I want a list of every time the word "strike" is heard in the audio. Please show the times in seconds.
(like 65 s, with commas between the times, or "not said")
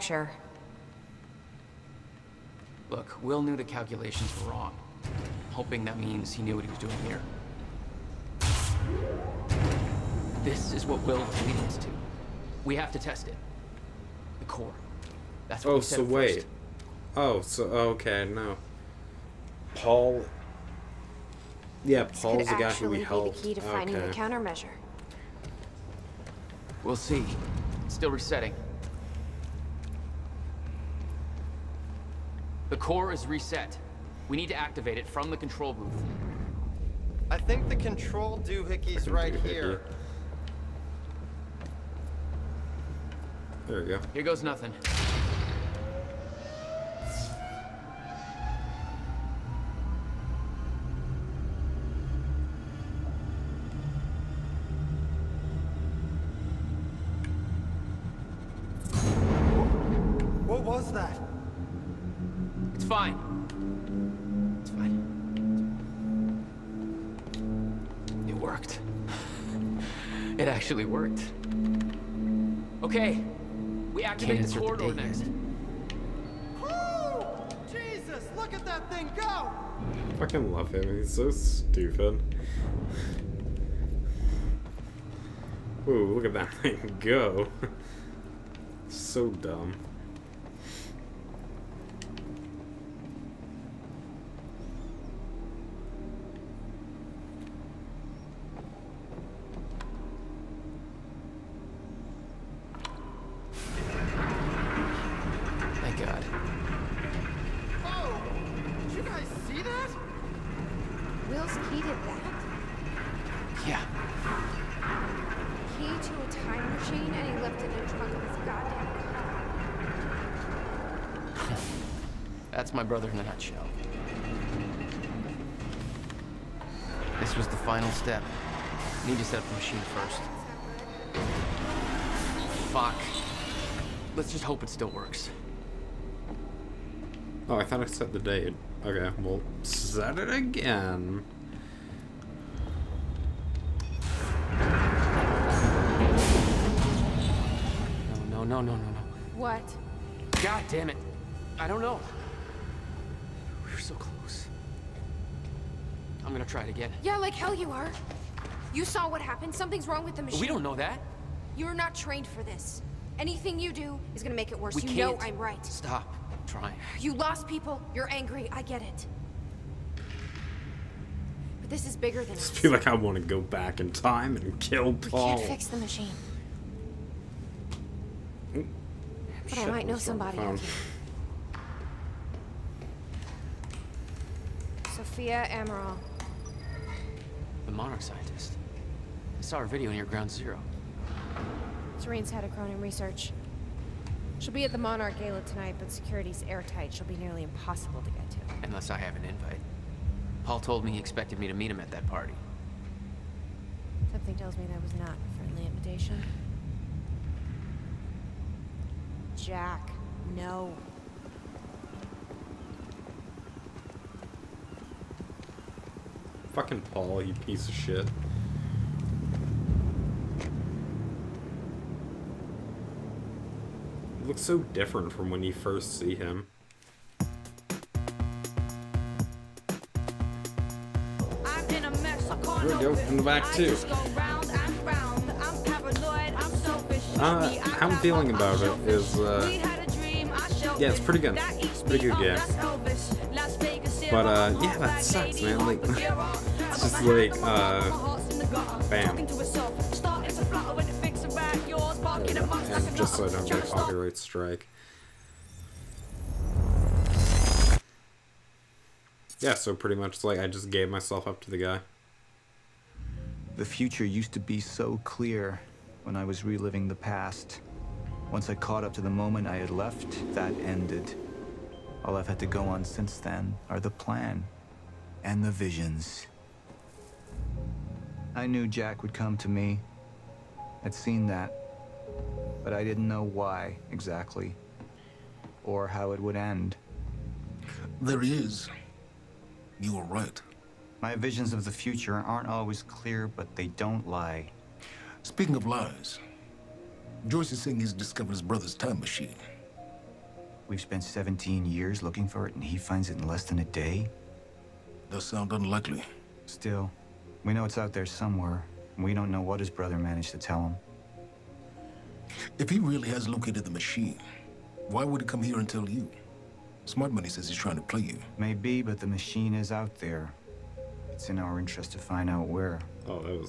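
254 s.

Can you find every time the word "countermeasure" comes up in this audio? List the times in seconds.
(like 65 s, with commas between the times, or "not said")
24 s.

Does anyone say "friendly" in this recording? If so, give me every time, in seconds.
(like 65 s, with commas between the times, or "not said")
205 s.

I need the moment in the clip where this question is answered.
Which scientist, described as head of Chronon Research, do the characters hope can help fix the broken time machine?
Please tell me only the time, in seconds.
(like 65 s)
184 s.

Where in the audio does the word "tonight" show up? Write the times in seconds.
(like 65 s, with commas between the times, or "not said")
195 s.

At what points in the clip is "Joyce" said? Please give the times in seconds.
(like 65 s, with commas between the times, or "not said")
297 s.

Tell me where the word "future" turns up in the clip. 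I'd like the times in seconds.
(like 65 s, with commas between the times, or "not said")
263 s, 291 s.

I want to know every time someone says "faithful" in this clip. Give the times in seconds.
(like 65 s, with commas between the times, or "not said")
not said.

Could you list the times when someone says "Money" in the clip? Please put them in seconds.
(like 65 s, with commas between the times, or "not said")
317 s.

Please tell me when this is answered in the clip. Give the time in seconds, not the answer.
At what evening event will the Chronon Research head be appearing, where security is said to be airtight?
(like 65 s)
194 s.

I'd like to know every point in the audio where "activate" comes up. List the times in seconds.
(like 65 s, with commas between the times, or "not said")
34 s, 74 s.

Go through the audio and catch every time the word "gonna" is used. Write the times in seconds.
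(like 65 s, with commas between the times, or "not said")
156 s, 164 s.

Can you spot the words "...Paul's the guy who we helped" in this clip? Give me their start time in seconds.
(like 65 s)
22 s.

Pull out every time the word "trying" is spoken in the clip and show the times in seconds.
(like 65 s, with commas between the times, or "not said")
166 s, 317 s.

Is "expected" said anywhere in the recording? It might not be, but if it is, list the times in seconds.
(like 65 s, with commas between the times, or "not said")
200 s.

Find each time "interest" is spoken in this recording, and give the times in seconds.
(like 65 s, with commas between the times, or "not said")
321 s.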